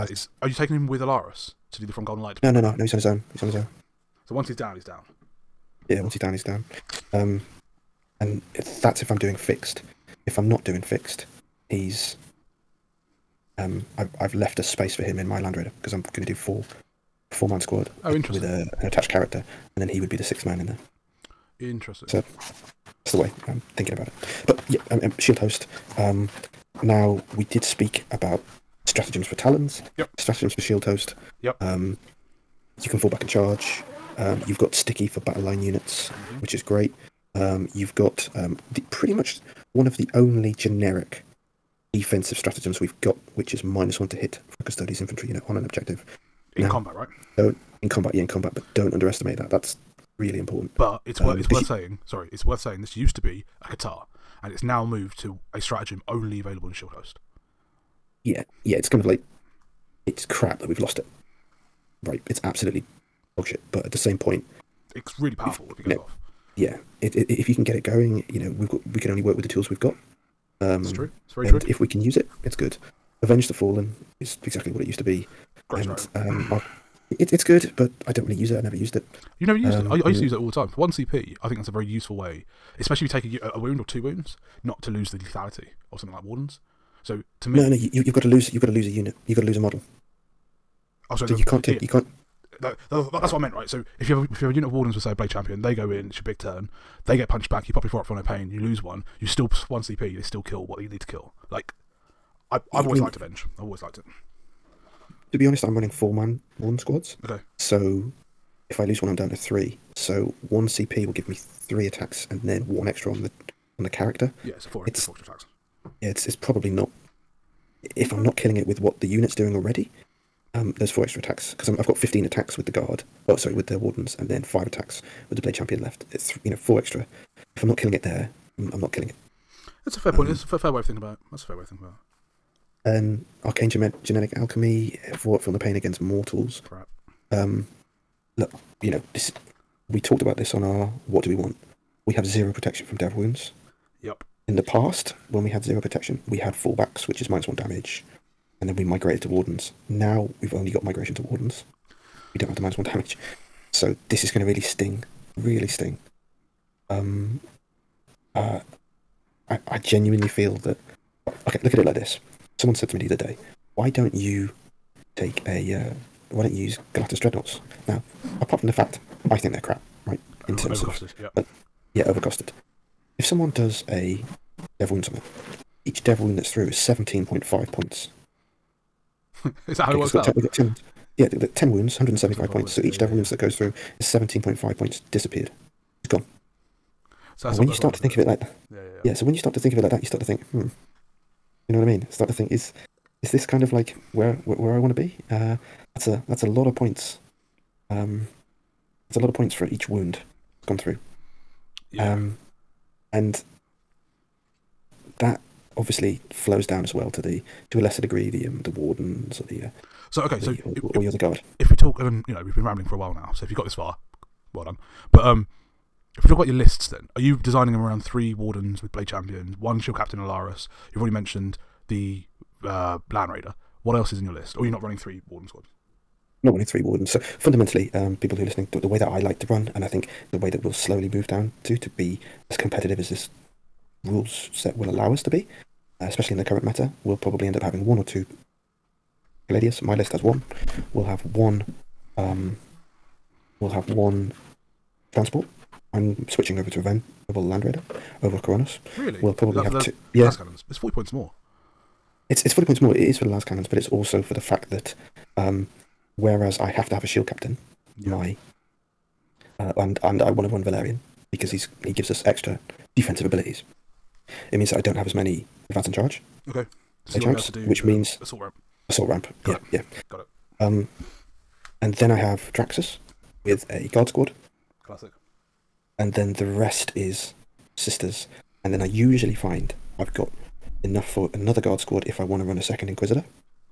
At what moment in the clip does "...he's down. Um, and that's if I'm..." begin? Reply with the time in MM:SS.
00:06.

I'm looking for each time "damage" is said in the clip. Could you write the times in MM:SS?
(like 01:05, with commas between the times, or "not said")
02:27, 02:32.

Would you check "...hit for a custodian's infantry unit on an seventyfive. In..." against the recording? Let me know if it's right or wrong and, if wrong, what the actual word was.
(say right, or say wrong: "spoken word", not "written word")
wrong: "objective", not "seventyfive".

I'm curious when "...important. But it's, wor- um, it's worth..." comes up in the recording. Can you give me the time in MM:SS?
00:50.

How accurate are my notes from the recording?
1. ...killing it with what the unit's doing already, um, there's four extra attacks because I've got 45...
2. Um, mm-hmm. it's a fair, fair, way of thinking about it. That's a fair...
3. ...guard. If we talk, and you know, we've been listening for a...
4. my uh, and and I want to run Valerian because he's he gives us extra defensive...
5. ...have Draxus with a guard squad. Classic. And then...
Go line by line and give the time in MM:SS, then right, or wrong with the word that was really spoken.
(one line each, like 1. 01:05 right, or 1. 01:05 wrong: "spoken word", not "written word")
1. 01:58 wrong: "15", not "45"
2. 02:10 right
3. 03:31 wrong: "rambling", not "listening"
4. 04:18 right
5. 04:32 right.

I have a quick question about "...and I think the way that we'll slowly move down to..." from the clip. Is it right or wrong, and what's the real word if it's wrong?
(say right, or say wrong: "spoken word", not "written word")
right.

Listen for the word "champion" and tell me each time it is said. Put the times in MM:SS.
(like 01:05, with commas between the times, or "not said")
01:35, 02:05, 03:39.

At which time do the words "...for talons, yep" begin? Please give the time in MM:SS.
00:29.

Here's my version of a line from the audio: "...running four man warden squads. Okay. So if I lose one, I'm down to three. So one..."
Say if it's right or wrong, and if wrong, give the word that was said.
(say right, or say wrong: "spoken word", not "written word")
right.